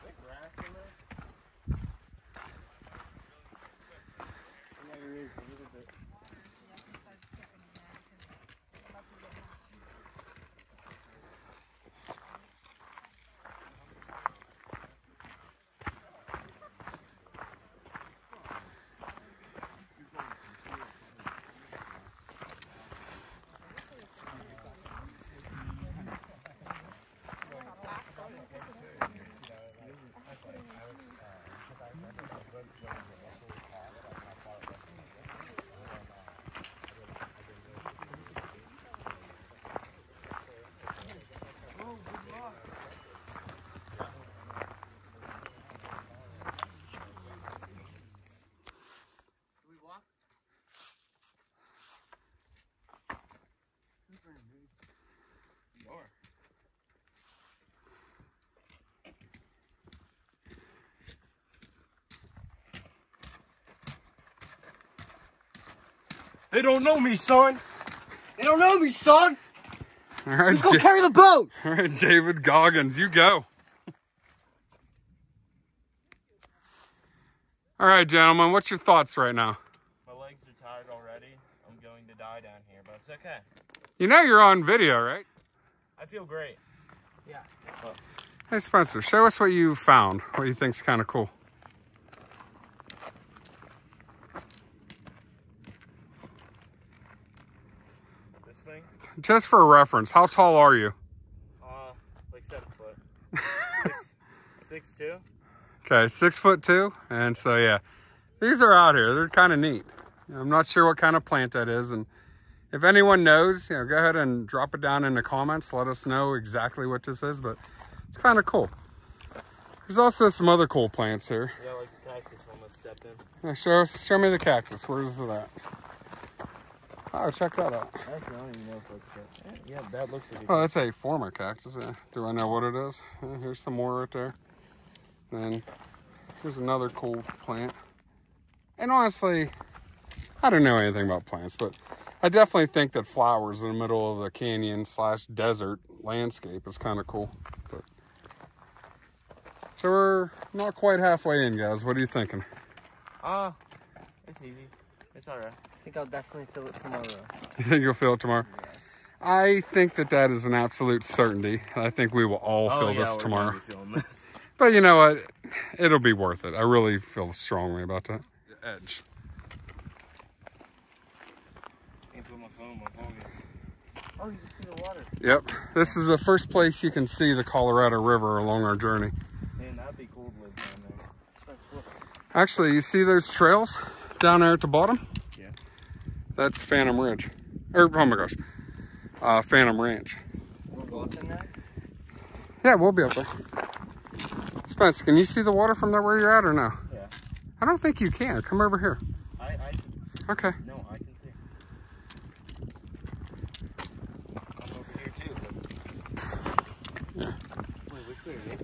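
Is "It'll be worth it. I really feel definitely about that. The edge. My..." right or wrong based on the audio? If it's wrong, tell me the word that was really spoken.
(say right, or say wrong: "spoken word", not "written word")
wrong: "strongly", not "definitely".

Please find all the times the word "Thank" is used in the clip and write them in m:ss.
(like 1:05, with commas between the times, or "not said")
0:32.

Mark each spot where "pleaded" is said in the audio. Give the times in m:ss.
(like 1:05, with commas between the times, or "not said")
not said.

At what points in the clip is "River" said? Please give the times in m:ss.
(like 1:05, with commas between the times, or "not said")
2:58.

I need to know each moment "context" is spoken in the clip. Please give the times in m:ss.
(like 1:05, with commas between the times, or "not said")
not said.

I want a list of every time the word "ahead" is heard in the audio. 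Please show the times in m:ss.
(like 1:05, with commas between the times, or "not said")
1:53.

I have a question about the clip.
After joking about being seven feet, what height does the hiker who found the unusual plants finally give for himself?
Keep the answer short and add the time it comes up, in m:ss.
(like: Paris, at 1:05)
6 foot 2, at 1:46.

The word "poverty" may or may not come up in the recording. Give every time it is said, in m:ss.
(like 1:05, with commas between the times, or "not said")
not said.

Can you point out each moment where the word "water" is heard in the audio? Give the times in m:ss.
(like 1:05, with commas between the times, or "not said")
2:54, 3:15.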